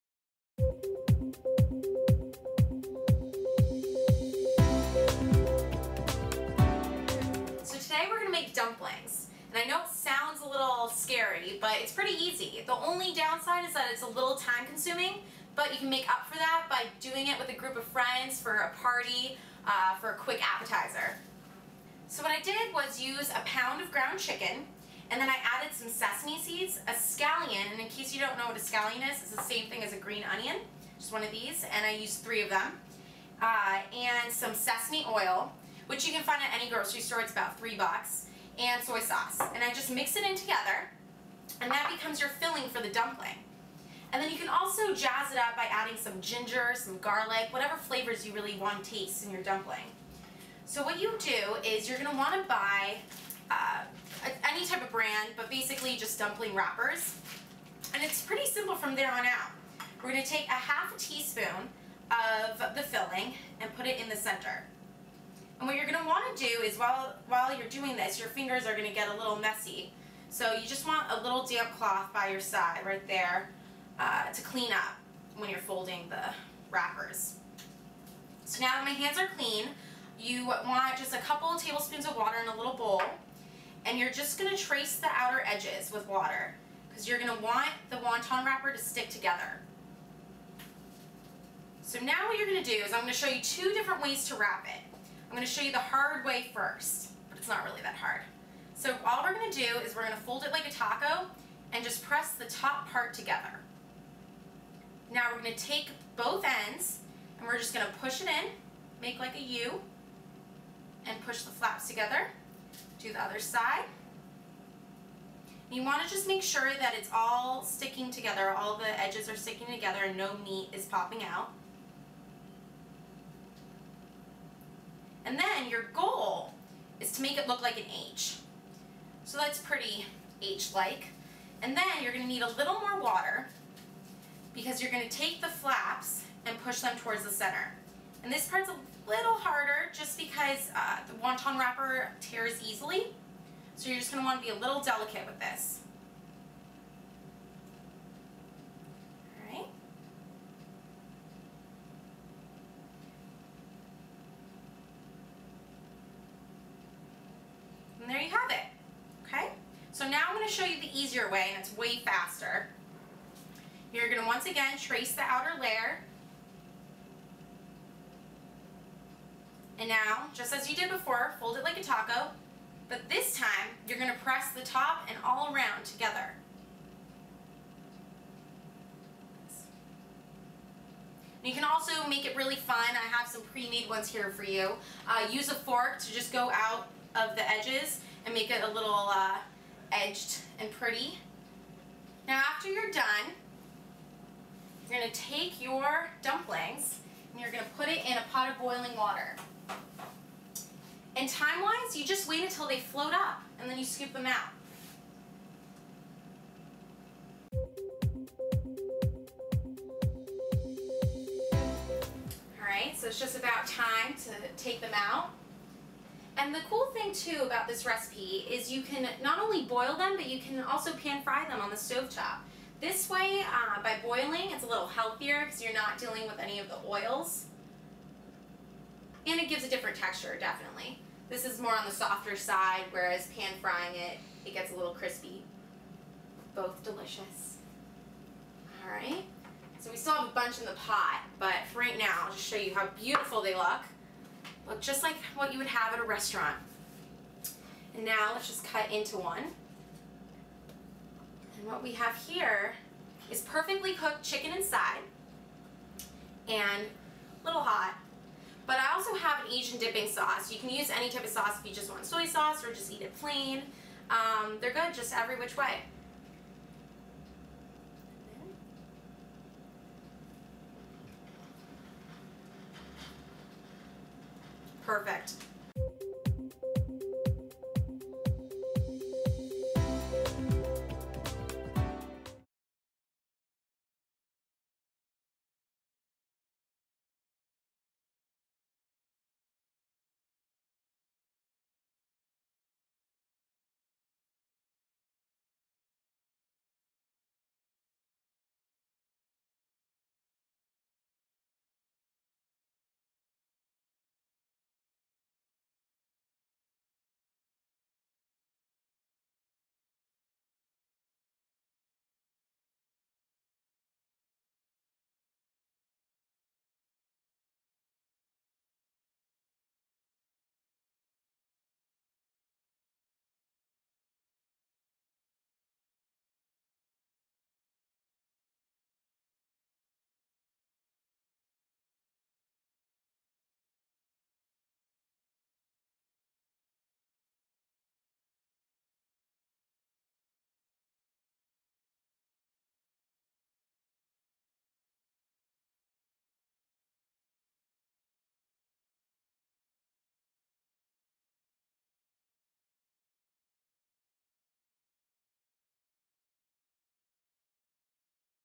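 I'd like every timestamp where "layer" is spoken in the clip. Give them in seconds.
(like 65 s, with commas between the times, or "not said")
165 s.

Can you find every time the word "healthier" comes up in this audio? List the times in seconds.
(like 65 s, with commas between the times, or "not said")
224 s.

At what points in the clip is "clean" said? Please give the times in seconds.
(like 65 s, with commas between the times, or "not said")
74 s, 79 s.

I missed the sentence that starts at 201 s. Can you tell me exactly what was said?
And time-wise, you just wait until they float up and then you scoop them out.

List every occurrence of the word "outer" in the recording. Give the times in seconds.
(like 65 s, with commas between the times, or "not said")
85 s, 165 s.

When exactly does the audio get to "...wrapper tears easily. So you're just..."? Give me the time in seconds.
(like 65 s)
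141 s.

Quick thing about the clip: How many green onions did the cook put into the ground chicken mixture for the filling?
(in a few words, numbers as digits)
3.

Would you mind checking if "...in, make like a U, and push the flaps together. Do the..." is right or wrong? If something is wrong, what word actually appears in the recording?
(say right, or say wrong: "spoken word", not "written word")
right.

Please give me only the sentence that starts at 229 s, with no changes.
And it gives a different texture, definitely.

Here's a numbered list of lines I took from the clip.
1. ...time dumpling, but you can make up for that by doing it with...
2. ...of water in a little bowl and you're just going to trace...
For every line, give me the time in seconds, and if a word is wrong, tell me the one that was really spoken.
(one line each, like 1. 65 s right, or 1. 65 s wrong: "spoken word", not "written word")
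1. 14 s wrong: "consuming", not "dumpling"
2. 82 s right.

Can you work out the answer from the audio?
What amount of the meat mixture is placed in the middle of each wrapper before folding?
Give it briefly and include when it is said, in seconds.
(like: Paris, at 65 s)
half a teaspoon, at 60 s.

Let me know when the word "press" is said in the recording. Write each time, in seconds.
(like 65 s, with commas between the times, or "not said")
102 s, 174 s.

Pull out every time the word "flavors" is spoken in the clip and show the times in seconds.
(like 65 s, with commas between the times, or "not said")
47 s.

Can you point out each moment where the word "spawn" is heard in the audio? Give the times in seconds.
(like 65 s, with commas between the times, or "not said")
not said.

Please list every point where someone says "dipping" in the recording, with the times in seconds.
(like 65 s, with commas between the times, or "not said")
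259 s.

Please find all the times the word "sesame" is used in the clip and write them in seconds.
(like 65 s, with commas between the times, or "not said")
25 s, 34 s.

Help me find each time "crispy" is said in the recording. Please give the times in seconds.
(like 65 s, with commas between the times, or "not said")
234 s.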